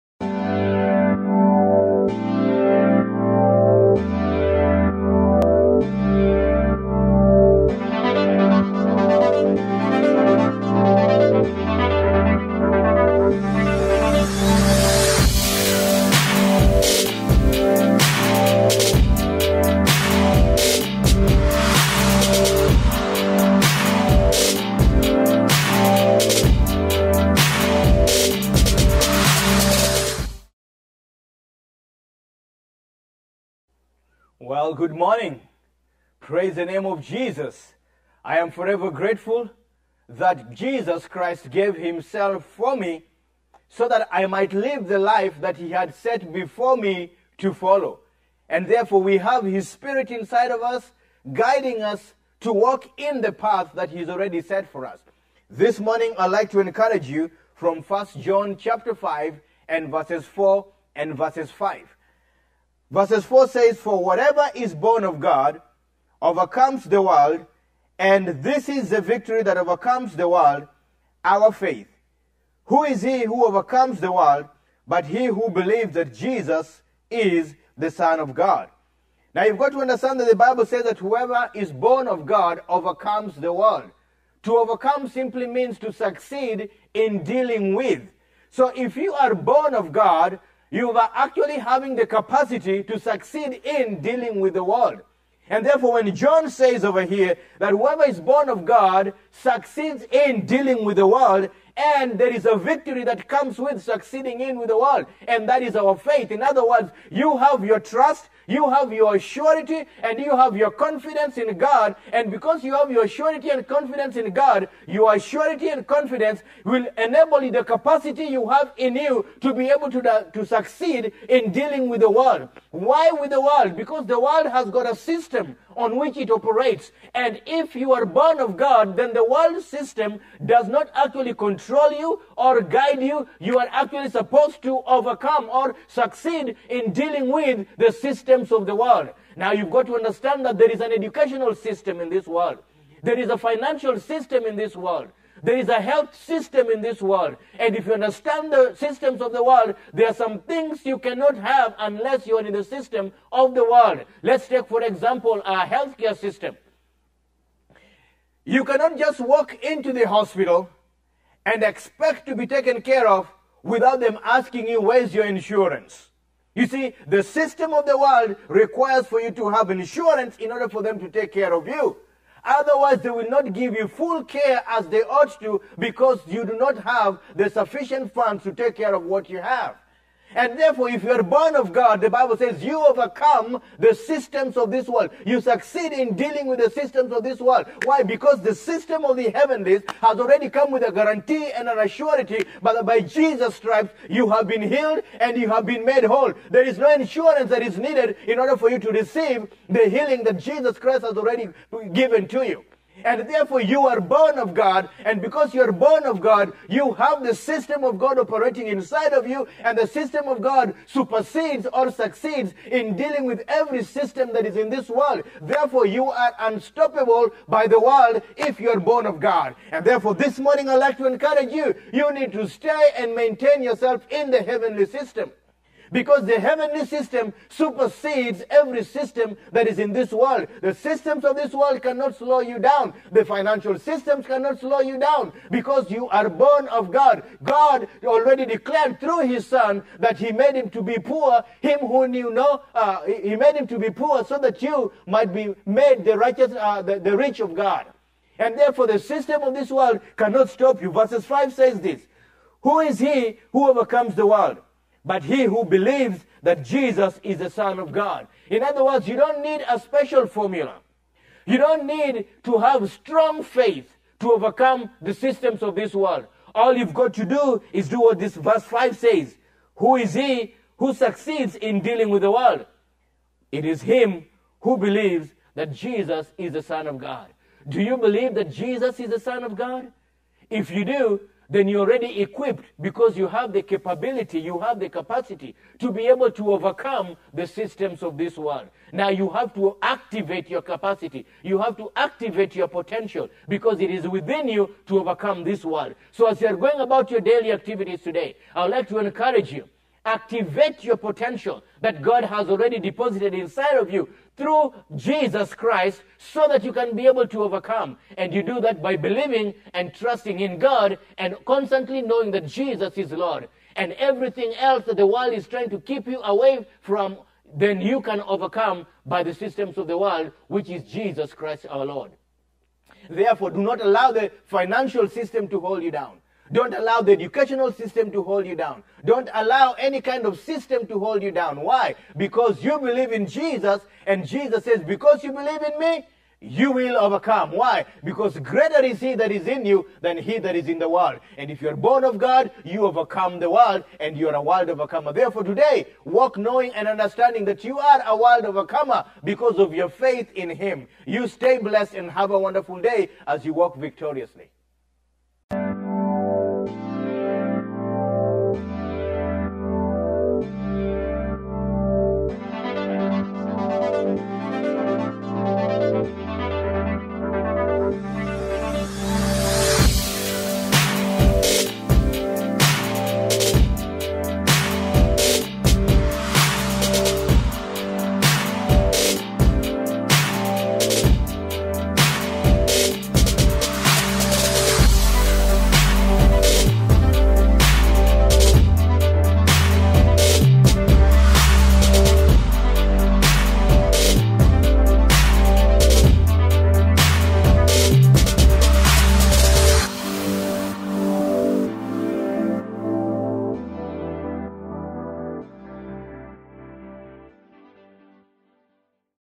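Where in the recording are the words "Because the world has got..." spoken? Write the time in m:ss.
2:03.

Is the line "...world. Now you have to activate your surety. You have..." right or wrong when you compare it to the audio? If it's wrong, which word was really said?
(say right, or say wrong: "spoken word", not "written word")
wrong: "capacity", not "surety".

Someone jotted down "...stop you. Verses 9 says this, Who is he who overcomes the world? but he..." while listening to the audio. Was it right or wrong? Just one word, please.
wrong.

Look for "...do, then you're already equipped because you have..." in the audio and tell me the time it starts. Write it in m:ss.
4:40.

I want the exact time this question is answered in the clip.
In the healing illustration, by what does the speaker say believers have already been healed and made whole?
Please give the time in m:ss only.
3:13.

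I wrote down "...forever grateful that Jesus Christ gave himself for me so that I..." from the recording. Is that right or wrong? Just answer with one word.
right.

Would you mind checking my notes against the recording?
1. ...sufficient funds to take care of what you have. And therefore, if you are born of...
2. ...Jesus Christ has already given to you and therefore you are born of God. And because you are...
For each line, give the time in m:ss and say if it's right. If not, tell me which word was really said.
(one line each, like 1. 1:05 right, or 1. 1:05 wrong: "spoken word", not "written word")
1. 2:57 right
2. 3:20 right.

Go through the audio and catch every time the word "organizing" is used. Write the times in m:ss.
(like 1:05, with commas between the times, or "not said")
not said.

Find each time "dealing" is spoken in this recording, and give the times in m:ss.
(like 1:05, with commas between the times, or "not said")
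1:27, 1:33, 1:40, 2:01, 2:16, 3:06, 3:32, 4:31.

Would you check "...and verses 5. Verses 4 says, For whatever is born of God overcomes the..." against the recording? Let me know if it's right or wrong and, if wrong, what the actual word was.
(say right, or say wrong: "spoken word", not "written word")
right.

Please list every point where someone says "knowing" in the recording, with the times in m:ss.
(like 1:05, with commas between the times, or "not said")
5:12, 5:46.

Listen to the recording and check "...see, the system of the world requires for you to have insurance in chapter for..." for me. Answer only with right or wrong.
wrong.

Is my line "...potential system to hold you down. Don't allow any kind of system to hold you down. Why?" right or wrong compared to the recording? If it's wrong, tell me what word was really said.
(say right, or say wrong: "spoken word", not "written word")
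wrong: "educational", not "potential".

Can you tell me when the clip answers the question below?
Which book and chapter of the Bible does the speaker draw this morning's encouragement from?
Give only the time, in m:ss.
0:57.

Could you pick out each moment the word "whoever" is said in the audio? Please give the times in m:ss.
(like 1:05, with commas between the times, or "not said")
1:20, 1:37.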